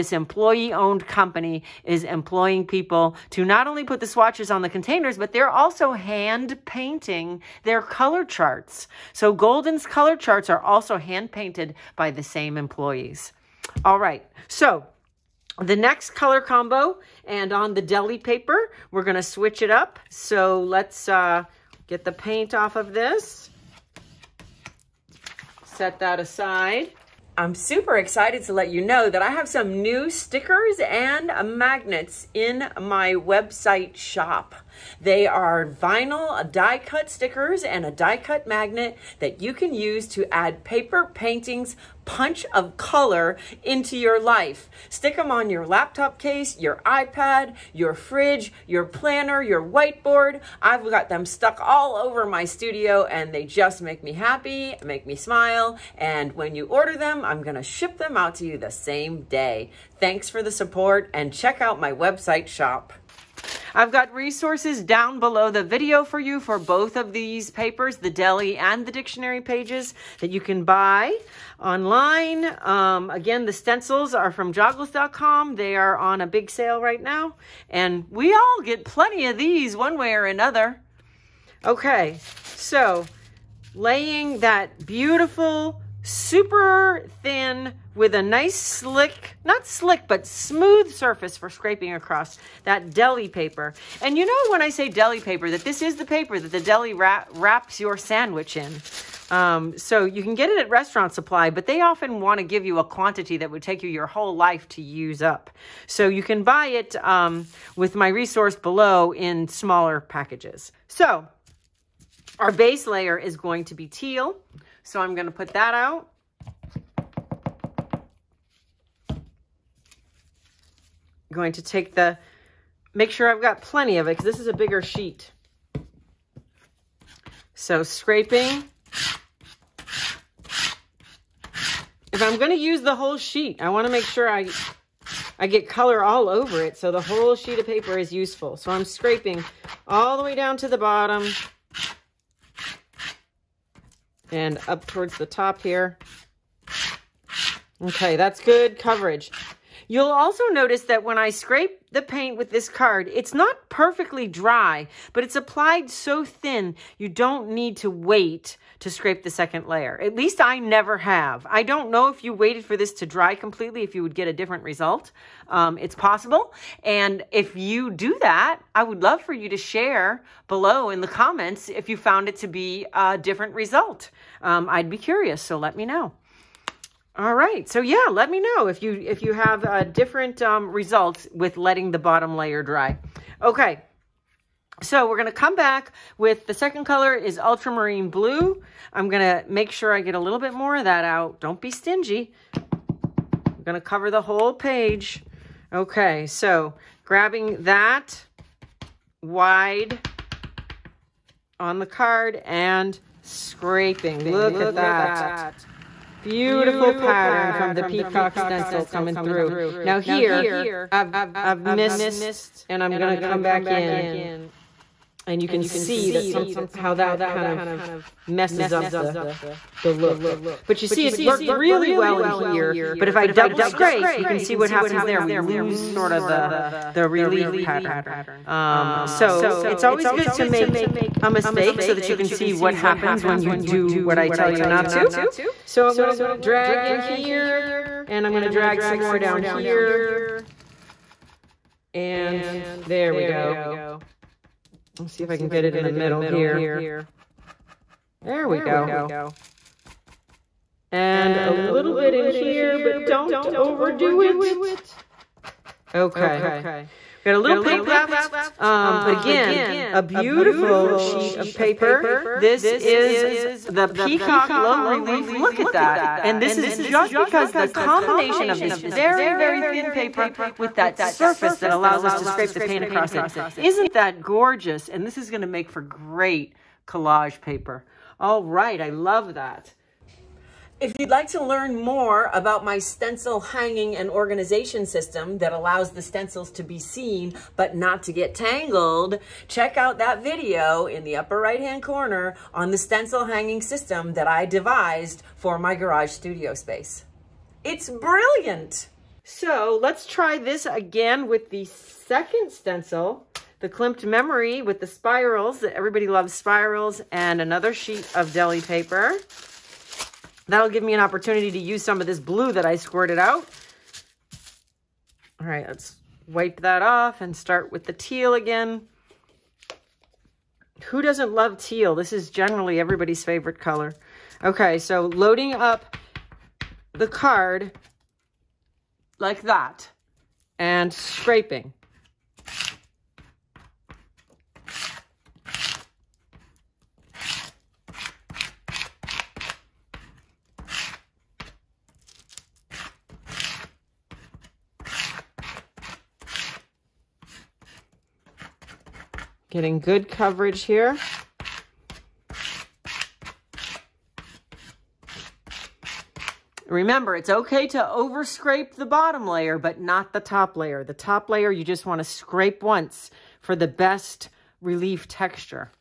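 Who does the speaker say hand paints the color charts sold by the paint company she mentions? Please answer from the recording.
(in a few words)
the same employees.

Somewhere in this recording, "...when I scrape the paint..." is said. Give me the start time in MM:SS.
02:31.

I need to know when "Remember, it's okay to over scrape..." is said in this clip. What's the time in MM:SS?
05:56.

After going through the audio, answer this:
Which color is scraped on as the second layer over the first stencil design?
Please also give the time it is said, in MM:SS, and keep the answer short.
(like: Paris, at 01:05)
ultramarine blue, at 03:07.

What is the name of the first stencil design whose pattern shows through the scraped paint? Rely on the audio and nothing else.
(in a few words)
peacock low relief.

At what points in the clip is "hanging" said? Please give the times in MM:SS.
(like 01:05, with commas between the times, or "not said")
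04:43, 04:53.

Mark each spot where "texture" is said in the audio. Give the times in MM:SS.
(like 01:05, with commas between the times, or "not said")
06:05.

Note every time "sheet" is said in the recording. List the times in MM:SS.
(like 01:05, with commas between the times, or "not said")
02:04, 02:13, 02:17, 04:20, 05:07.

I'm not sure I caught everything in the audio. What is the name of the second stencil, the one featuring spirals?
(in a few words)
Klimt Memory.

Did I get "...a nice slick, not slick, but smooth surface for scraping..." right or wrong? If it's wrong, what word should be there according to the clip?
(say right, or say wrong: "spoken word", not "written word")
right.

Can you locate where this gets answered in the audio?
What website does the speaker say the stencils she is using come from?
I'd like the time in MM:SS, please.
01:14.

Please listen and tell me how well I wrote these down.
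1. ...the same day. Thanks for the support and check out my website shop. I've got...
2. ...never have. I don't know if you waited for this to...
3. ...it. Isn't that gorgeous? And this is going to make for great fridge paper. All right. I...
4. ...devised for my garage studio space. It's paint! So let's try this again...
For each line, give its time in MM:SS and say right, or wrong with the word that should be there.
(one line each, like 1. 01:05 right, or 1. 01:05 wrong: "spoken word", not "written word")
1. 00:58 right
2. 02:40 right
3. 04:33 wrong: "collage", not "fridge"
4. 04:54 wrong: "brilliant", not "paint".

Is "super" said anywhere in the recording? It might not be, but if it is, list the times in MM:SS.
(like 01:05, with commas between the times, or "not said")
00:27, 01:26.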